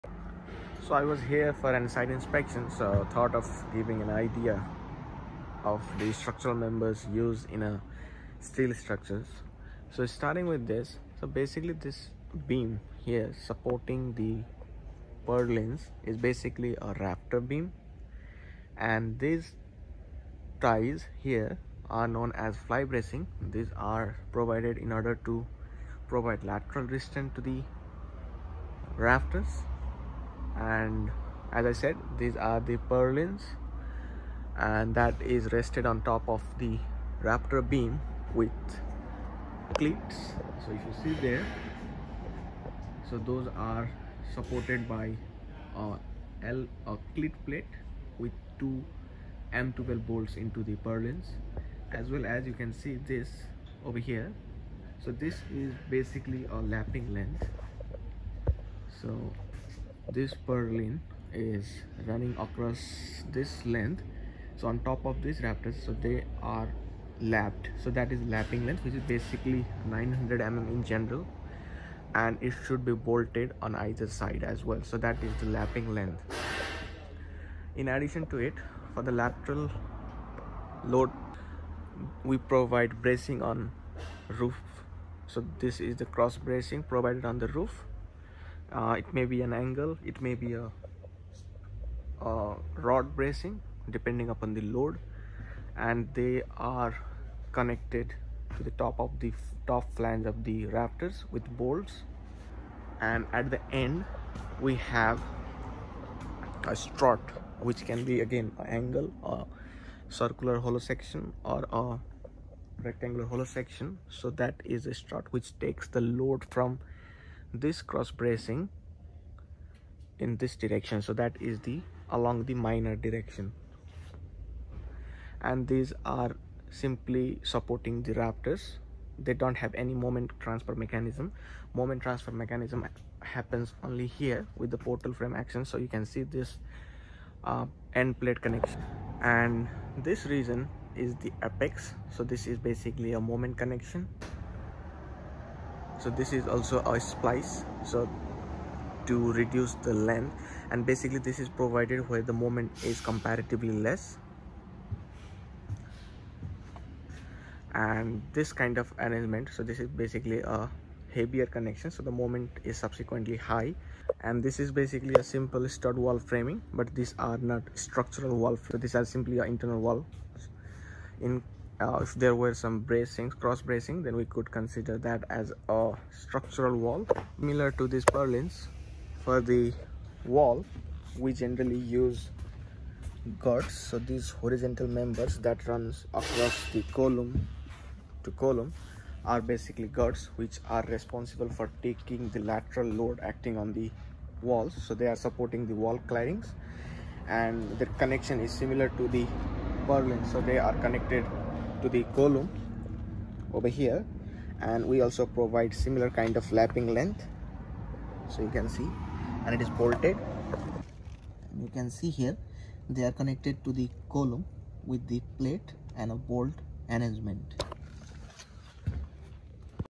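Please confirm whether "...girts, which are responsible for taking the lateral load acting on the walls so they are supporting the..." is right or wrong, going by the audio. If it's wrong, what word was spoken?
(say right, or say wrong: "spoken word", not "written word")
right.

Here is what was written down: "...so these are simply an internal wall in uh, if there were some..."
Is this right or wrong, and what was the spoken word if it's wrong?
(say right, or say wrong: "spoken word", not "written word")
right.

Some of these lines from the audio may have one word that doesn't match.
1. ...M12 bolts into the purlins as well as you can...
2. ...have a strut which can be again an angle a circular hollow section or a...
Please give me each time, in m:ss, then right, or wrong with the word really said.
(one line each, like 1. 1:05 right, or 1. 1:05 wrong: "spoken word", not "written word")
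1. 0:49 right
2. 1:44 right.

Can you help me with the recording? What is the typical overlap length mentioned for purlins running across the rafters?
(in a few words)
900 mm.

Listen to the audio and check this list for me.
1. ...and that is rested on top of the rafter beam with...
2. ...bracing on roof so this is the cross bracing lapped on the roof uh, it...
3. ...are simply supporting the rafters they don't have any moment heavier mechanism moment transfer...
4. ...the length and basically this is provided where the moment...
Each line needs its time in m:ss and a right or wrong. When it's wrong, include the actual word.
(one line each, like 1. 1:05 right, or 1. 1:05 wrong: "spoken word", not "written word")
1. 0:34 right
2. 1:23 wrong: "provided", not "lapped"
3. 2:06 wrong: "transfer", not "heavier"
4. 2:29 right.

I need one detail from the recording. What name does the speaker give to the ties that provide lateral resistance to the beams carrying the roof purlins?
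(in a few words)
fly bracing.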